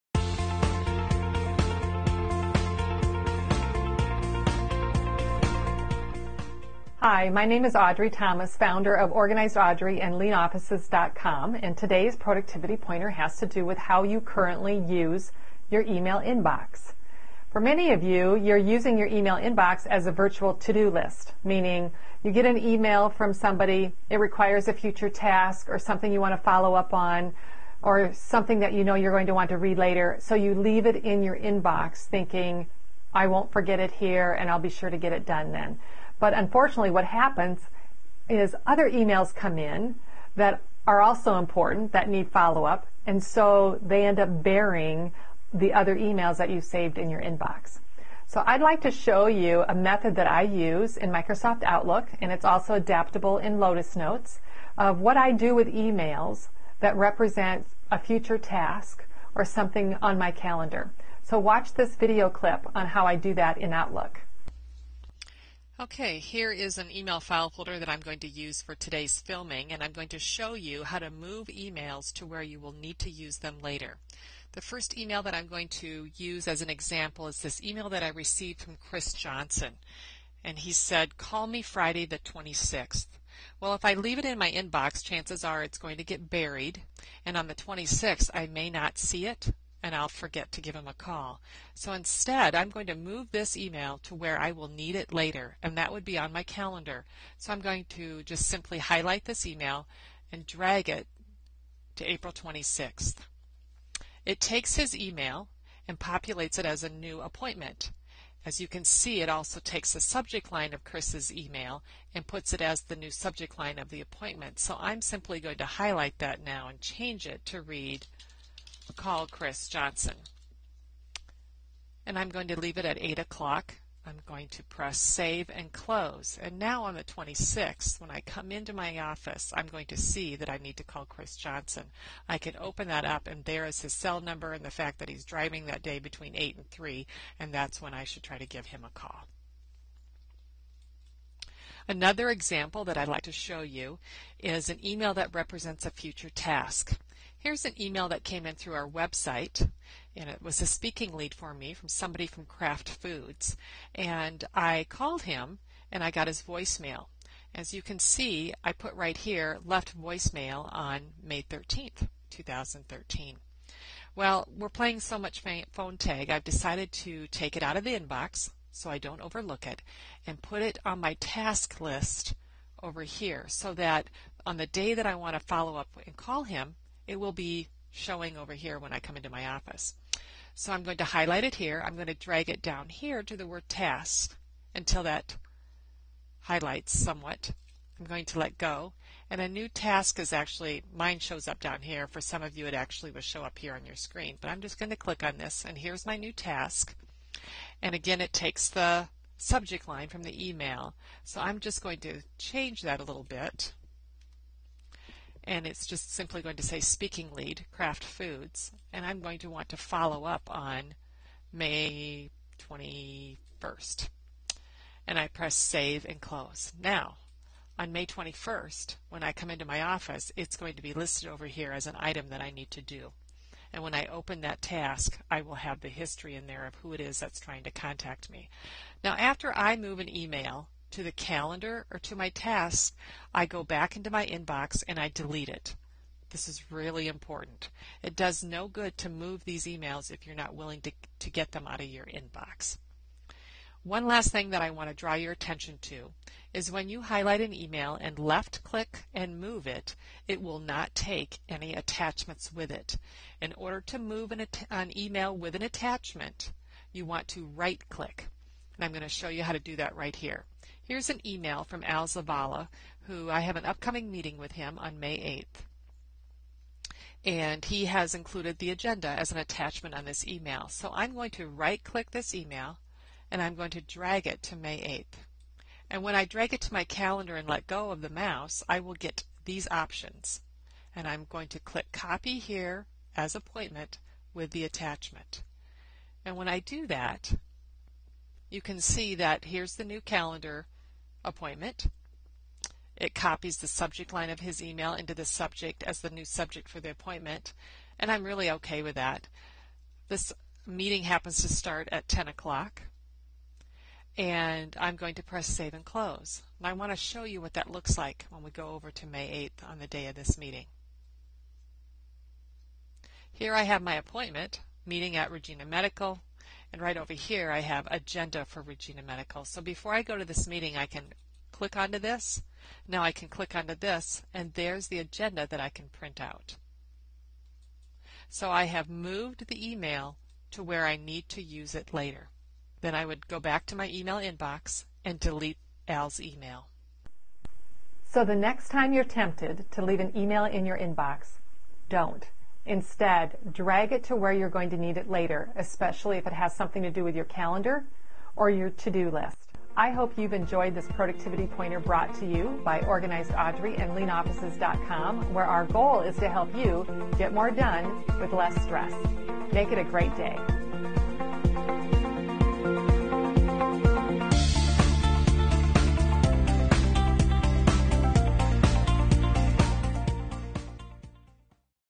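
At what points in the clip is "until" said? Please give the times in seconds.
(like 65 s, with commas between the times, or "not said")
184 s.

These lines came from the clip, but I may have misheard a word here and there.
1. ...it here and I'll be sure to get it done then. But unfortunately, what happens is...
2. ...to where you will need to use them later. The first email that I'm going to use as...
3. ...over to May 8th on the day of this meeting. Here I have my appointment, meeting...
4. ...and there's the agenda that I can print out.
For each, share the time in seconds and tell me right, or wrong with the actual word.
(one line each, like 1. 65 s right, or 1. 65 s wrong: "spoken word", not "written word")
1. 33 s right
2. 72 s right
3. 308 s right
4. 324 s right.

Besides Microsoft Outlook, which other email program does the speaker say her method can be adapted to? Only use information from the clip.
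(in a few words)
Lotus Notes.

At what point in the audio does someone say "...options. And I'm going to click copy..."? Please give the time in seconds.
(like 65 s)
279 s.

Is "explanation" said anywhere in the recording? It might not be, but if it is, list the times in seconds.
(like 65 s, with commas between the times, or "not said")
not said.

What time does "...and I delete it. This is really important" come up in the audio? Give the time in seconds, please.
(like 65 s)
234 s.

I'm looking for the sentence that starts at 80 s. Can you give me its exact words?
And he said, call me Friday the 26th.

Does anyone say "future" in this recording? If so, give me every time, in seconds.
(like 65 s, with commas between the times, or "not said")
24 s, 57 s, 145 s.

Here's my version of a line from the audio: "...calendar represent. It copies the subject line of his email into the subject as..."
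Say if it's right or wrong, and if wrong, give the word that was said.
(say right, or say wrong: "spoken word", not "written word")
wrong: "appointment", not "represent".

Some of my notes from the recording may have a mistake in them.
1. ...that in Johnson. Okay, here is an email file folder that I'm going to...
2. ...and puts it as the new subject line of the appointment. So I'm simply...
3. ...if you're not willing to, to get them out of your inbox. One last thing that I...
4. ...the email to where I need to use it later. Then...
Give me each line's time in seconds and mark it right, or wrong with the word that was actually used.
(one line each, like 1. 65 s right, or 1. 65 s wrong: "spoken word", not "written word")
1. 63 s wrong: "Outlook", not "Johnson"
2. 112 s right
3. 240 s right
4. 329 s right.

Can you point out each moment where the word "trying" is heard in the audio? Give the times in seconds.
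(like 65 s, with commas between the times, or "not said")
227 s.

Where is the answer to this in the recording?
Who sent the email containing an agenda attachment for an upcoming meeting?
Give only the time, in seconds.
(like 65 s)
261 s.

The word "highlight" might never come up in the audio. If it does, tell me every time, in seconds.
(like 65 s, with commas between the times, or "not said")
98 s, 115 s, 181 s, 186 s, 247 s.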